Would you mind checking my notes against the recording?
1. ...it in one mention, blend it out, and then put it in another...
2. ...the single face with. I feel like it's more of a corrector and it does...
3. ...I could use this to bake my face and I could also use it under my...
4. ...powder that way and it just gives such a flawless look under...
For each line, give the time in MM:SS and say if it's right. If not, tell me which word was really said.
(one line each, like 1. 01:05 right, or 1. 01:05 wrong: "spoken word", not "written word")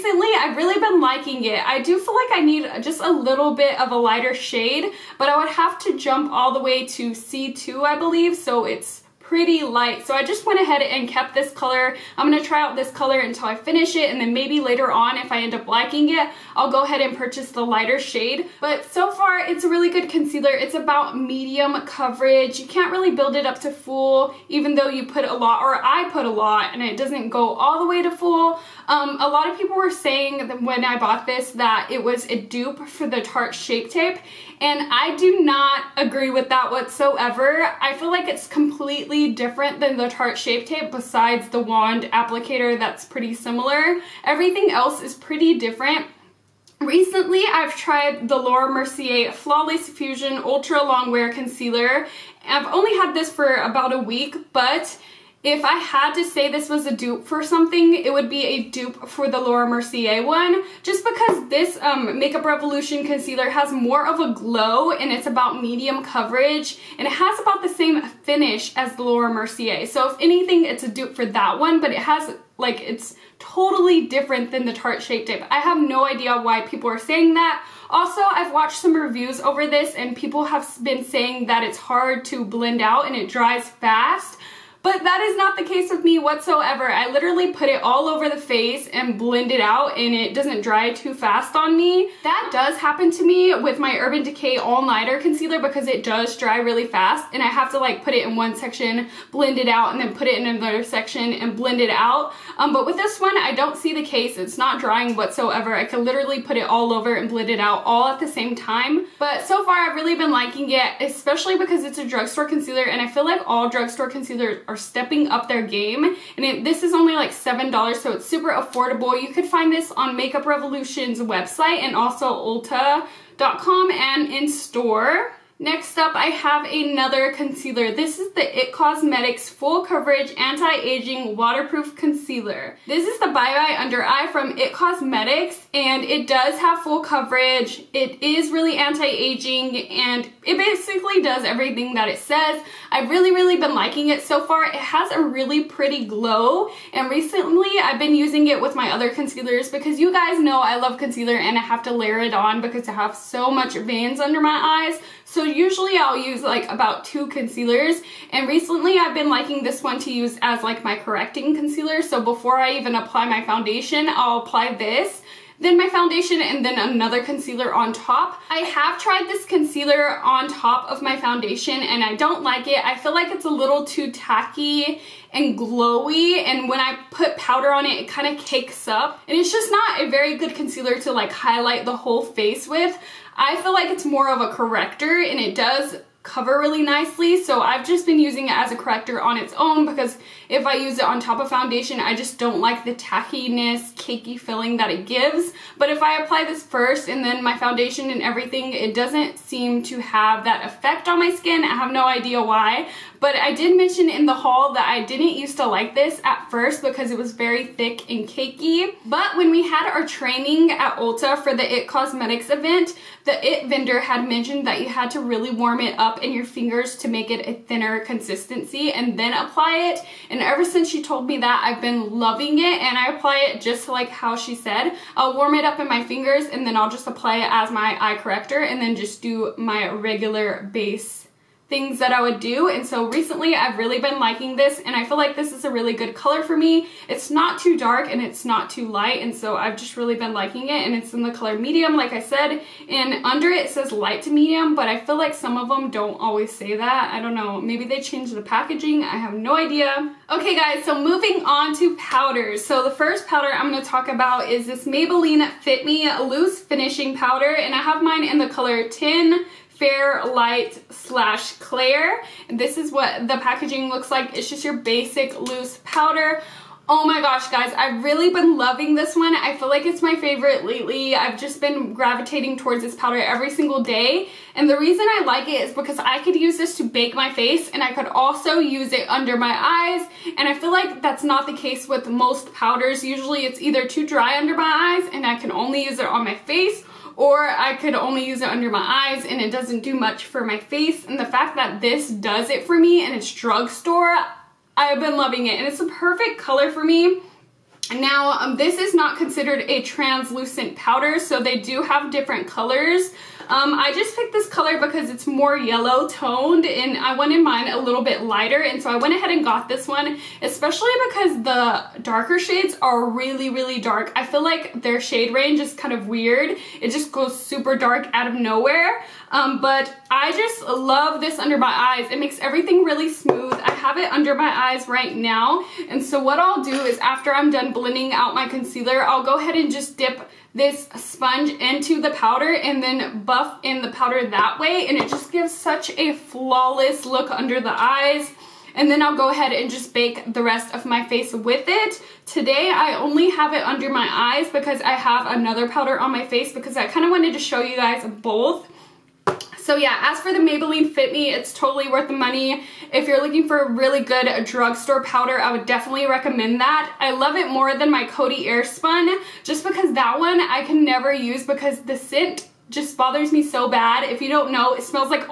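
1. 01:38 wrong: "section", not "mention"
2. 03:01 wrong: "whole", not "single"
3. 04:35 right
4. 05:33 right.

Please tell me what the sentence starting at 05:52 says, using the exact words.
If you're looking for a really good drugstore powder, I would definitely recommend that.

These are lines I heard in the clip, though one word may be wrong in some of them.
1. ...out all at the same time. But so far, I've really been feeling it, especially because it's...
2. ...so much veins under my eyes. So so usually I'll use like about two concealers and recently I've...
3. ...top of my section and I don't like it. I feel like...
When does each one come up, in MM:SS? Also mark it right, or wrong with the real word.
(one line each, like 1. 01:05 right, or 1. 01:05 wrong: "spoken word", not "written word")
1. 01:47 wrong: "liking", not "feeling"
2. 02:33 right
3. 02:50 wrong: "foundation", not "section".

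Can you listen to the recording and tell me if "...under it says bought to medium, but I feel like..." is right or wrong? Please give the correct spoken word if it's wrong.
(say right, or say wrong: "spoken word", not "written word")
wrong: "light", not "bought".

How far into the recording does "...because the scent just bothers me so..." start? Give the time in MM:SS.
06:01.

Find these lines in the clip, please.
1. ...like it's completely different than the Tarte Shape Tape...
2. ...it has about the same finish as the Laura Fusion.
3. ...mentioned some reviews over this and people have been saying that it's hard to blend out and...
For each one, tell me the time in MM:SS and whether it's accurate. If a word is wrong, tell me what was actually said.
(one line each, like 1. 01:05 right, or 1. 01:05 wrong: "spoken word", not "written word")
1. 00:38 right
2. 01:07 wrong: "Mercier", not "Fusion"
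3. 01:18 wrong: "watched", not "mentioned".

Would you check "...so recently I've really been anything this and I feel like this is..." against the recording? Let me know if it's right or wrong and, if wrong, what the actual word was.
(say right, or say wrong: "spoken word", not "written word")
wrong: "liking", not "anything".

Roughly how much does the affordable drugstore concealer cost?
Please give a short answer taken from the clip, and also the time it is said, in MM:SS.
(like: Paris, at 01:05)
$7, at 01:57.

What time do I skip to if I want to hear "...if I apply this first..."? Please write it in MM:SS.
03:15.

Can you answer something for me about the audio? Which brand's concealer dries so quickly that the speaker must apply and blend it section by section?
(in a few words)
Urban Decay.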